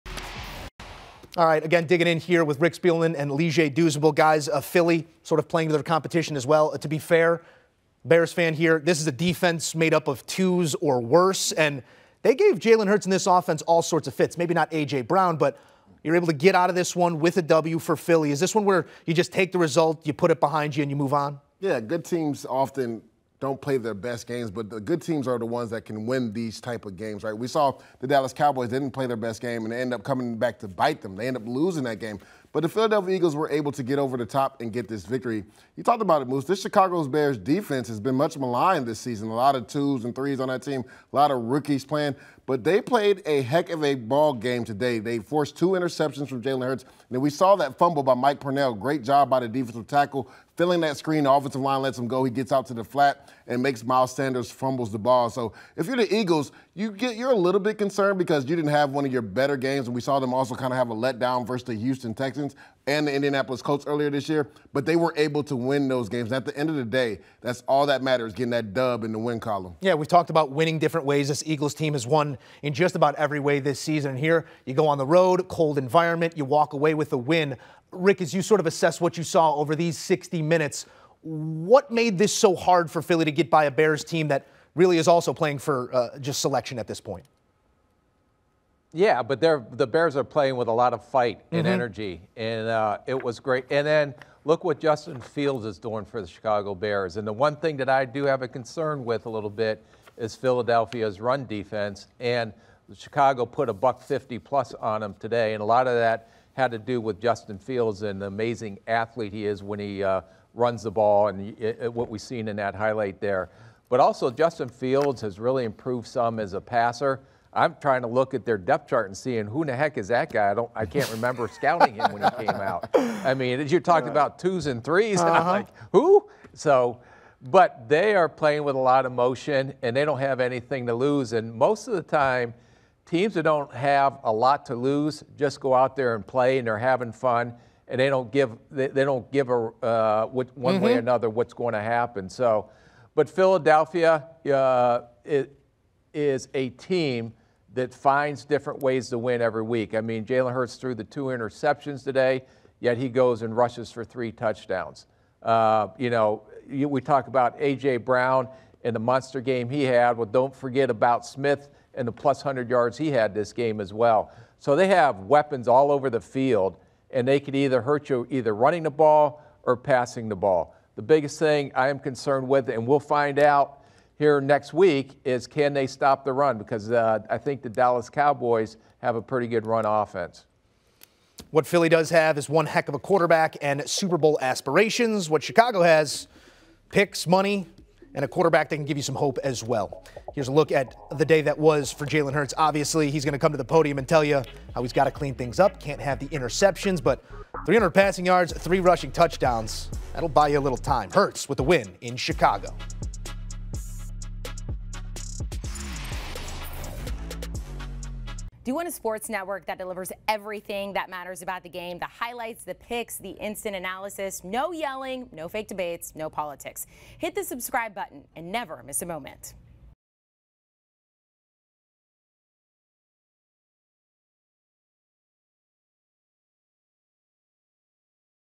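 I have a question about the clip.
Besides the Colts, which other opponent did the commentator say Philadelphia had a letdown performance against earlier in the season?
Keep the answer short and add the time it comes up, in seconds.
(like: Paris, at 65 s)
Houston Texans, at 61 s.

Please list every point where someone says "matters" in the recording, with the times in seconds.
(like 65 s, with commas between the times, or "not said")
68 s, 211 s.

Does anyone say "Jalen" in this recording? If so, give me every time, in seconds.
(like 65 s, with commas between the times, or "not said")
12 s, 46 s, 150 s, 192 s.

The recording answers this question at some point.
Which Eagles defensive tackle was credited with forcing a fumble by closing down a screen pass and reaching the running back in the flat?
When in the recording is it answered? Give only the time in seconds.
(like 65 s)
48 s.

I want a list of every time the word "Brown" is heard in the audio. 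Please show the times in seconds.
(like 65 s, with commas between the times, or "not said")
15 s, 157 s.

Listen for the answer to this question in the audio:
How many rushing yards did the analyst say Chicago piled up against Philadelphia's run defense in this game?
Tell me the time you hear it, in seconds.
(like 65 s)
103 s.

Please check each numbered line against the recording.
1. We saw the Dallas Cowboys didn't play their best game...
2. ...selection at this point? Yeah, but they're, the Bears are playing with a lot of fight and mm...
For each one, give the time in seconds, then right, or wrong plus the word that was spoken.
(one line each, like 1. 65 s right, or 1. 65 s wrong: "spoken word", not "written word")
1. 27 s right
2. 86 s right.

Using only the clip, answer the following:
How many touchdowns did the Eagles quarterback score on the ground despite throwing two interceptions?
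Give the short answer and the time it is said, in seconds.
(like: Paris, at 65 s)
3, at 154 s.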